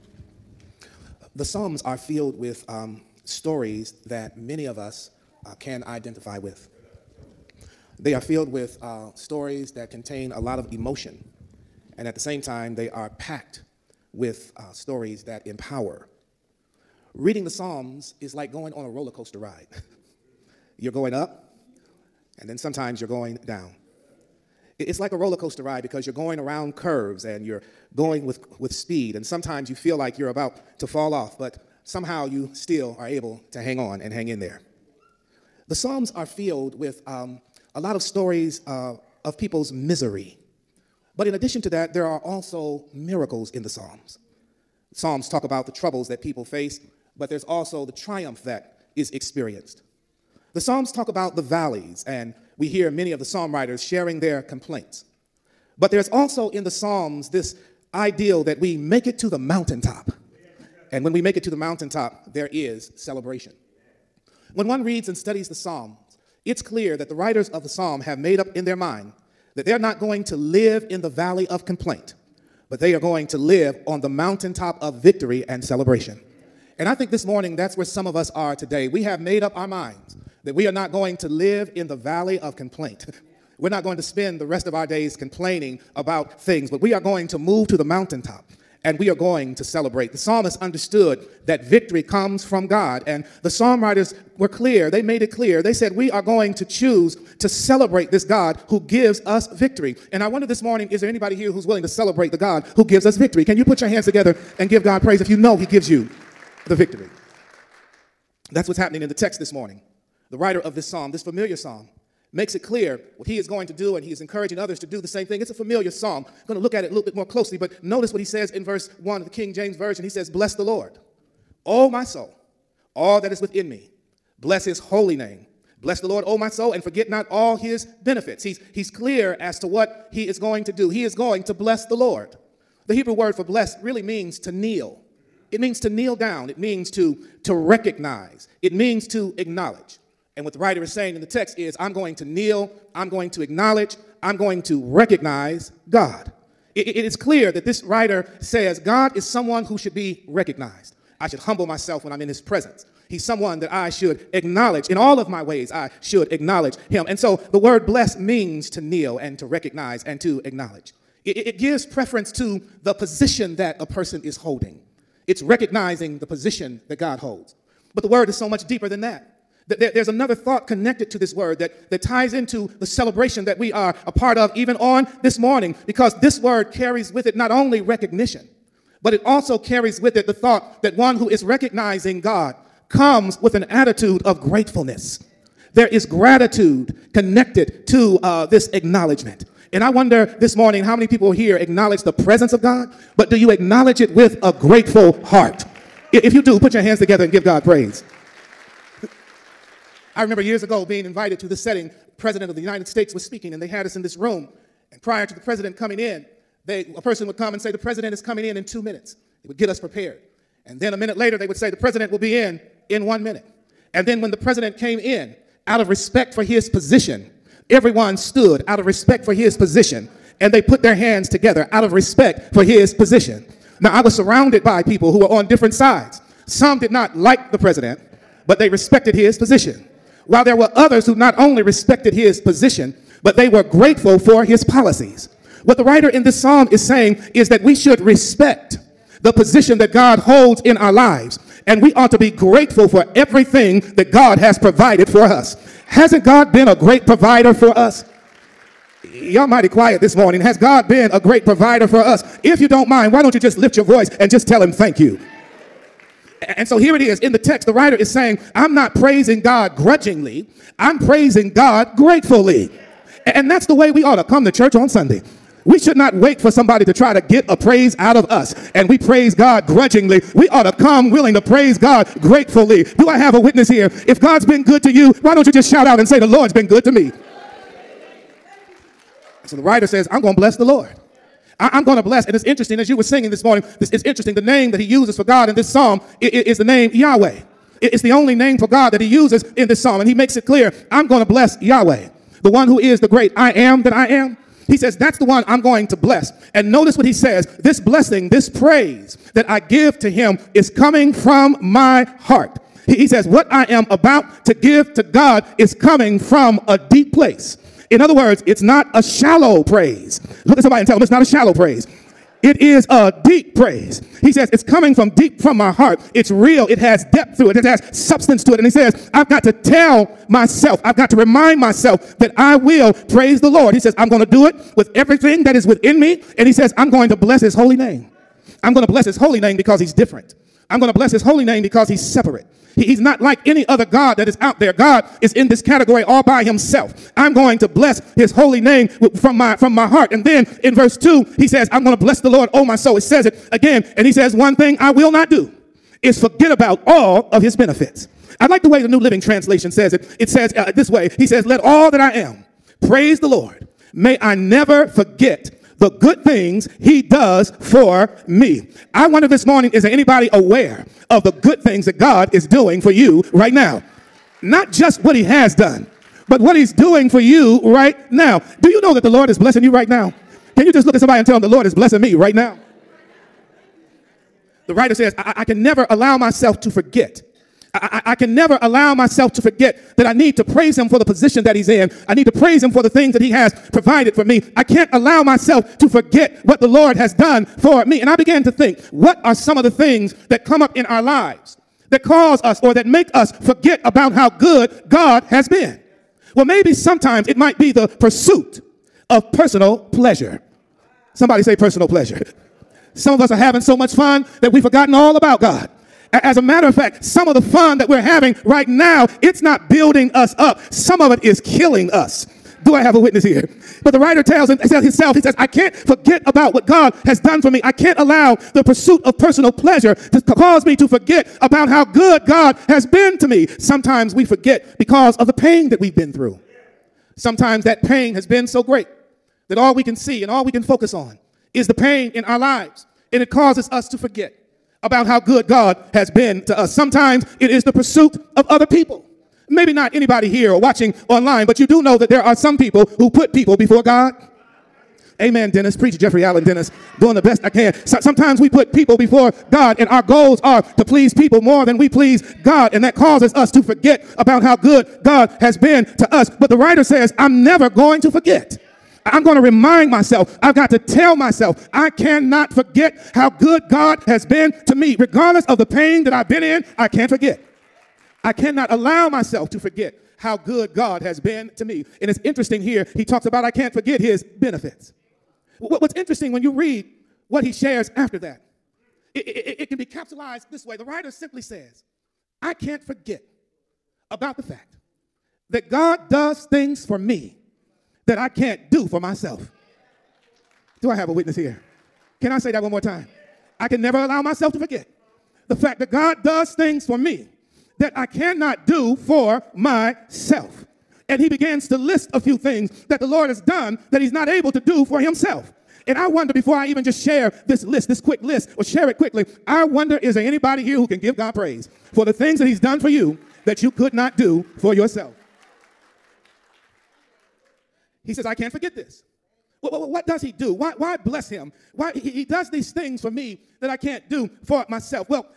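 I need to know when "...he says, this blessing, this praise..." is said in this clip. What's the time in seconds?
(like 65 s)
297 s.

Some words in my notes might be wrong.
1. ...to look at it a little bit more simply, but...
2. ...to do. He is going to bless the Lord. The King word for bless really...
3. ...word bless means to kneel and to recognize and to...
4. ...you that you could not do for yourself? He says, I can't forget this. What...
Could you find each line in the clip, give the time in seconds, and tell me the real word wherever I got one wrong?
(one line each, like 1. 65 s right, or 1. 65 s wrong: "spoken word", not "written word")
1. 116 s wrong: "closely", not "simply"
2. 130 s wrong: "Hebrew", not "King"
3. 157 s right
4. 512 s right.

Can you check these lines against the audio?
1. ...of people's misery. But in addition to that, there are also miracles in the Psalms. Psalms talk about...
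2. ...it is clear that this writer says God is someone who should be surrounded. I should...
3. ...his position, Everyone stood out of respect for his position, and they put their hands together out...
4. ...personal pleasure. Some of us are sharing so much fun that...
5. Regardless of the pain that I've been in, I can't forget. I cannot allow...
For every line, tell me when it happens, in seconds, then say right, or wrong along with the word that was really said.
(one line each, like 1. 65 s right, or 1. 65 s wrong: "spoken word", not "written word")
1. 39 s right
2. 146 s wrong: "recognized", not "surrounded"
3. 216 s right
4. 401 s wrong: "having", not "sharing"
5. 464 s right.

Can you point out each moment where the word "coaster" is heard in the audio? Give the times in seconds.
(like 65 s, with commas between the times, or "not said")
19 s, 25 s.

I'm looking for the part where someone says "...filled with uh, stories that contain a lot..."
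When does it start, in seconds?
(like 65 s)
8 s.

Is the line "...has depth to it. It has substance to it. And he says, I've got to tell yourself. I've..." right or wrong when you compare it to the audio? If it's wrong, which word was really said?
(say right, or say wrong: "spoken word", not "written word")
wrong: "myself", not "yourself".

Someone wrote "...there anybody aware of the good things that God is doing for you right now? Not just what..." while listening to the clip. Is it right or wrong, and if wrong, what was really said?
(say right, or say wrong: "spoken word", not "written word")
right.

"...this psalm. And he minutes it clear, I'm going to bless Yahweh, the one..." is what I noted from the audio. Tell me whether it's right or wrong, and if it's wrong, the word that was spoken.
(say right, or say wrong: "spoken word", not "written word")
wrong: "makes", not "minutes".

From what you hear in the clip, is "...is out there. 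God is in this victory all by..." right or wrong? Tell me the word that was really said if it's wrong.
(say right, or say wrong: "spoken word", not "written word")
wrong: "category", not "victory".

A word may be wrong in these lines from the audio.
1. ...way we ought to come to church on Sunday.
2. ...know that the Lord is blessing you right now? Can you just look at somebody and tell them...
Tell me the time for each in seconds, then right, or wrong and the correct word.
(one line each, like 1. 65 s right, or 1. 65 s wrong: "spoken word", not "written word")
1. 263 s right
2. 368 s right.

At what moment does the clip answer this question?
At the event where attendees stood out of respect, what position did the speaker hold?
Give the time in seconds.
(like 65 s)
202 s.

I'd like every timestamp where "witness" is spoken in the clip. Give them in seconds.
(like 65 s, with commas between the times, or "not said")
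273 s, 412 s, 491 s.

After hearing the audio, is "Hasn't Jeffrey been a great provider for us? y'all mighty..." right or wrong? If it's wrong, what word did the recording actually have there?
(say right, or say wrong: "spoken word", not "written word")
wrong: "God", not "Jeffrey".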